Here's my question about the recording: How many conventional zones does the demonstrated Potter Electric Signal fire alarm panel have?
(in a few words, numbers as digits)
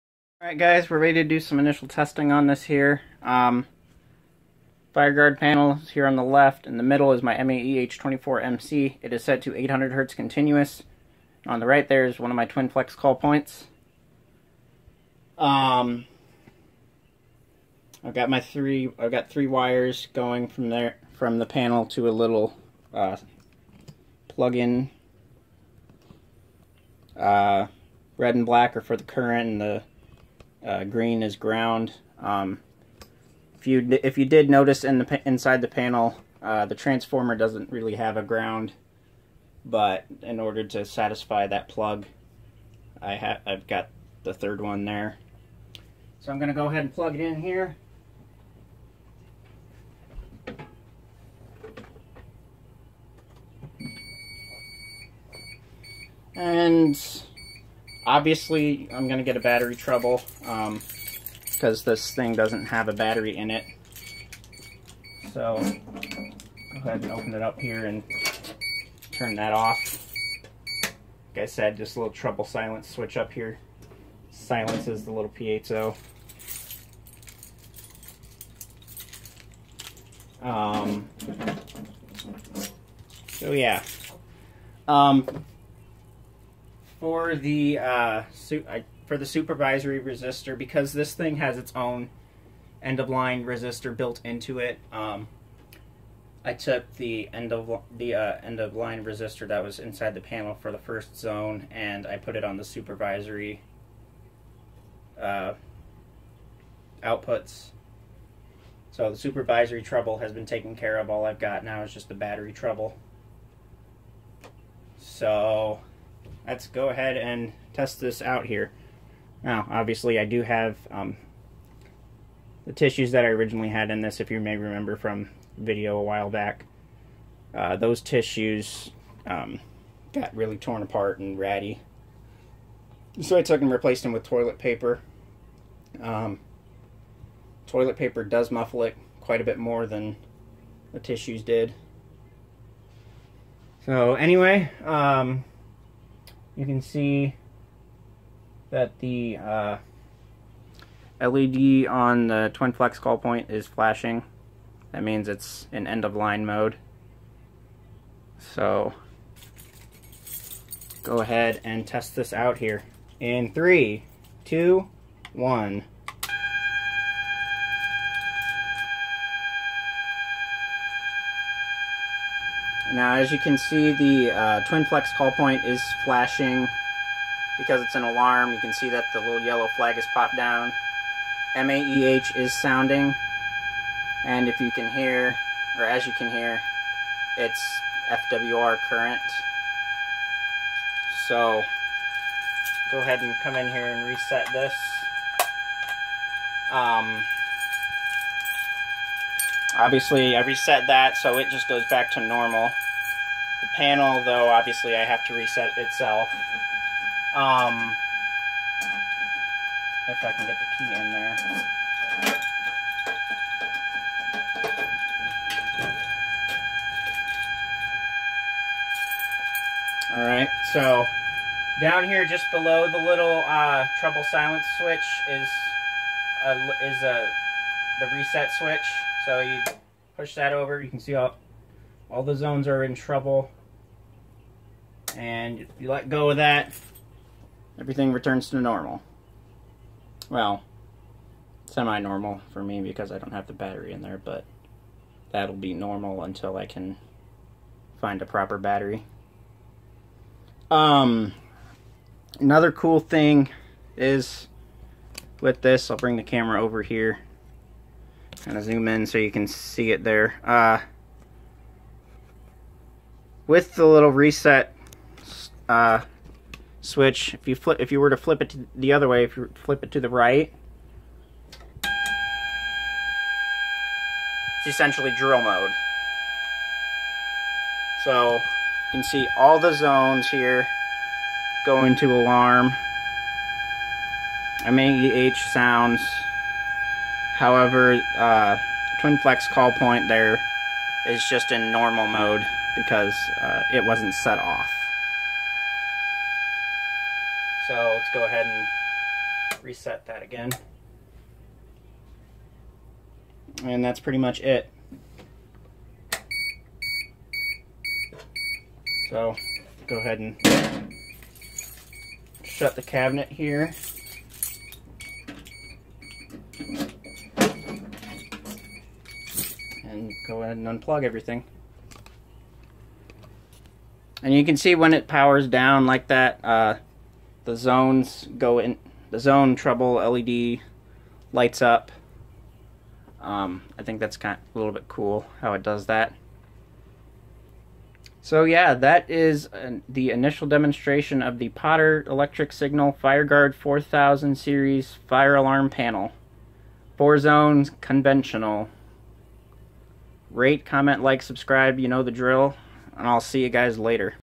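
4.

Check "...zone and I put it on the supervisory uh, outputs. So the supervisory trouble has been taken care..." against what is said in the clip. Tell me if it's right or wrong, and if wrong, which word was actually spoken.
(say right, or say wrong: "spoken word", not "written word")
right.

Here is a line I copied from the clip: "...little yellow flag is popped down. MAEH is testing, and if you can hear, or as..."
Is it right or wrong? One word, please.
wrong.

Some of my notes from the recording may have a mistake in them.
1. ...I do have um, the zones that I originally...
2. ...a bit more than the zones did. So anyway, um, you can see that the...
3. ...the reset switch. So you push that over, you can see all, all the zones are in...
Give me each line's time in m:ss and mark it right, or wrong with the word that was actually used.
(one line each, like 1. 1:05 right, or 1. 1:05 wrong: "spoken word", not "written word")
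1. 2:00 wrong: "tissues", not "zones"
2. 2:19 wrong: "tissues", not "zones"
3. 3:48 right.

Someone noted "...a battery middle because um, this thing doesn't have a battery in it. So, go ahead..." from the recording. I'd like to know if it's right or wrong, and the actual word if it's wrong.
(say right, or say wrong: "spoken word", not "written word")
wrong: "trouble", not "middle".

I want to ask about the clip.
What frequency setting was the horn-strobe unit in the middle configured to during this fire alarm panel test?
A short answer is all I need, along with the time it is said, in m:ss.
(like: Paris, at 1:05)
800 Hz, at 0:09.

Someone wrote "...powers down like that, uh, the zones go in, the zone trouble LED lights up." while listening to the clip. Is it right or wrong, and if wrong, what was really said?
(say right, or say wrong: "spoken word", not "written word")
right.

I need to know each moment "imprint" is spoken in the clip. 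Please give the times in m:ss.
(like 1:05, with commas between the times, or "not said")
not said.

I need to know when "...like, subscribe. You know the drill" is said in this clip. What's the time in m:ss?
5:51.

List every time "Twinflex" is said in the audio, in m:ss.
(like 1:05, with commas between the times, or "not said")
0:12, 2:32, 2:54, 4:49.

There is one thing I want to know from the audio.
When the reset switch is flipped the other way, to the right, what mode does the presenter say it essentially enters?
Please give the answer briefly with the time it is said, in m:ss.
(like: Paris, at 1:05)
Drill mode, at 4:35.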